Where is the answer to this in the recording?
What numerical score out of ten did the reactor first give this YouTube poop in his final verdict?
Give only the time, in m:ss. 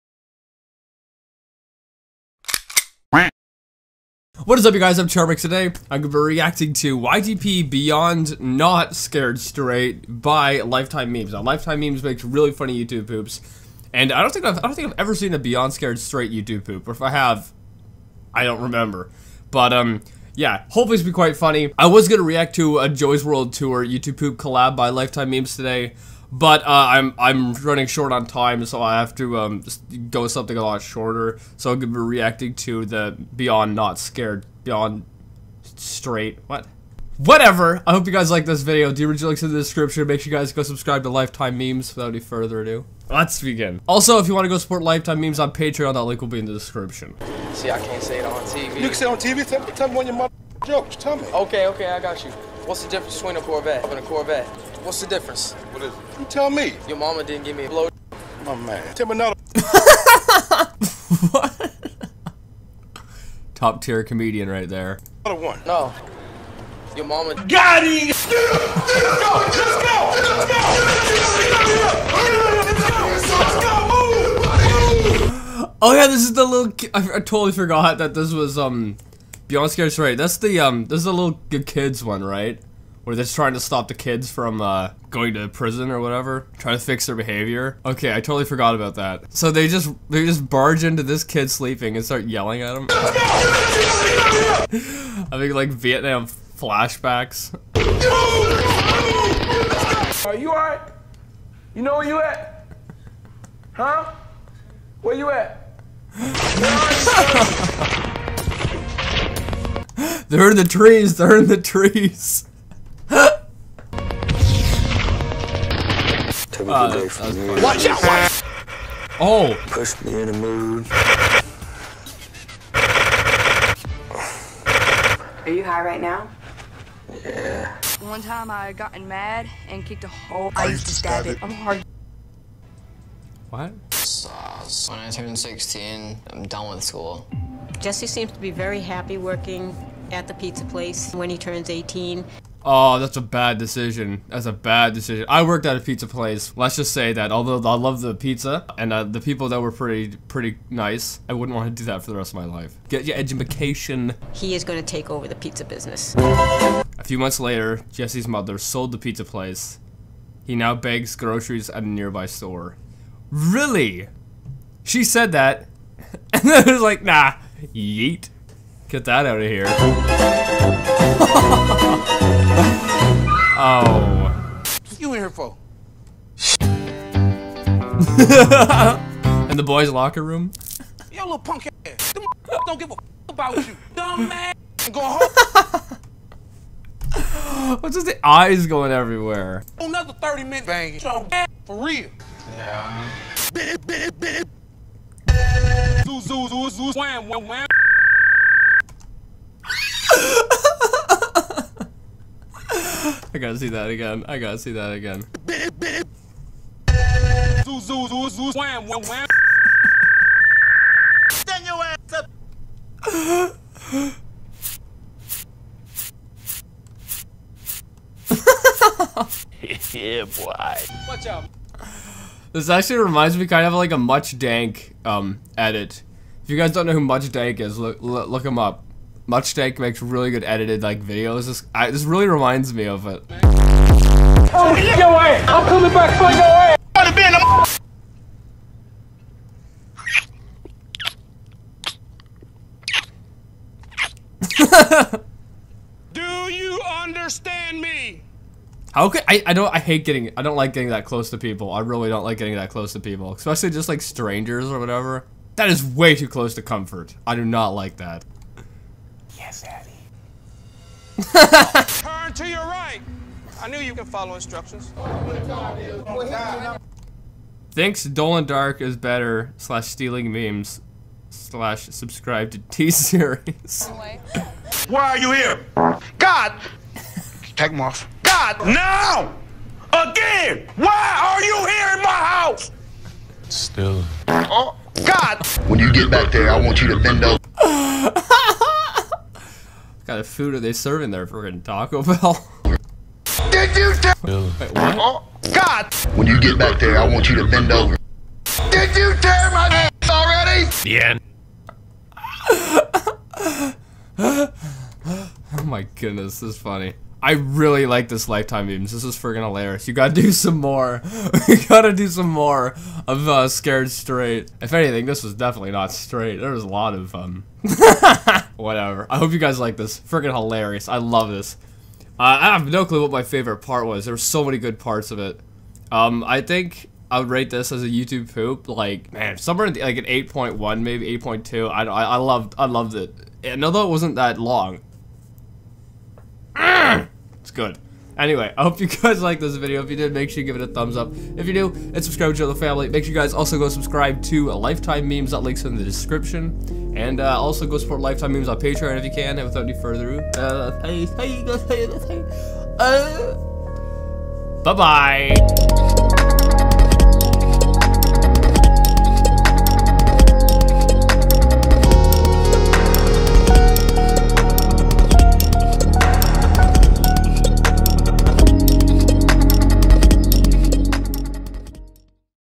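5:30.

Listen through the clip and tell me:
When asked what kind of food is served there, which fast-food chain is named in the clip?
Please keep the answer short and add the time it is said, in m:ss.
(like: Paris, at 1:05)
Taco Bell, at 4:51.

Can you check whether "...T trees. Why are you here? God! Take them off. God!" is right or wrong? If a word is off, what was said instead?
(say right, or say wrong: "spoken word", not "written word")
wrong: "series", not "trees".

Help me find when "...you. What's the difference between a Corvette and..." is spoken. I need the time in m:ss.
0:52.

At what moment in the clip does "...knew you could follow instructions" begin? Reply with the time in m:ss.
4:23.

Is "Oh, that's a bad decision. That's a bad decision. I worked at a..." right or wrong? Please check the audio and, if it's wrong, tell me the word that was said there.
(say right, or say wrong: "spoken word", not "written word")
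right.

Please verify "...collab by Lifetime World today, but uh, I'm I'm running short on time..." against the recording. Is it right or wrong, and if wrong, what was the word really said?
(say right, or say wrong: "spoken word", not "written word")
wrong: "Memes", not "World".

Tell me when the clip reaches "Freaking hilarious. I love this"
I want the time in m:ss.
5:19.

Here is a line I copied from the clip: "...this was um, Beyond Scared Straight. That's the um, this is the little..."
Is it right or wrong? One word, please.
right.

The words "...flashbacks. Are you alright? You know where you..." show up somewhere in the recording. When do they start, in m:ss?
1:36.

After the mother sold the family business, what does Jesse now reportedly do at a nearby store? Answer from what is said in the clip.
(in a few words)
Begs groceries.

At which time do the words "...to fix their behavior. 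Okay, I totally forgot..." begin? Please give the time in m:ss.
1:26.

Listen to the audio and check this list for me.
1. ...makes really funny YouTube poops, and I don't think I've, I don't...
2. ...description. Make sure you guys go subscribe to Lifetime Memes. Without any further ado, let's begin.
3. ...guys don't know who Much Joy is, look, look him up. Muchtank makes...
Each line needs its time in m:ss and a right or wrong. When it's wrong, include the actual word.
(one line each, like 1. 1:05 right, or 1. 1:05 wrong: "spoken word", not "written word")
1. 0:12 right
2. 0:39 right
3. 3:46 wrong: "Dank", not "Joy".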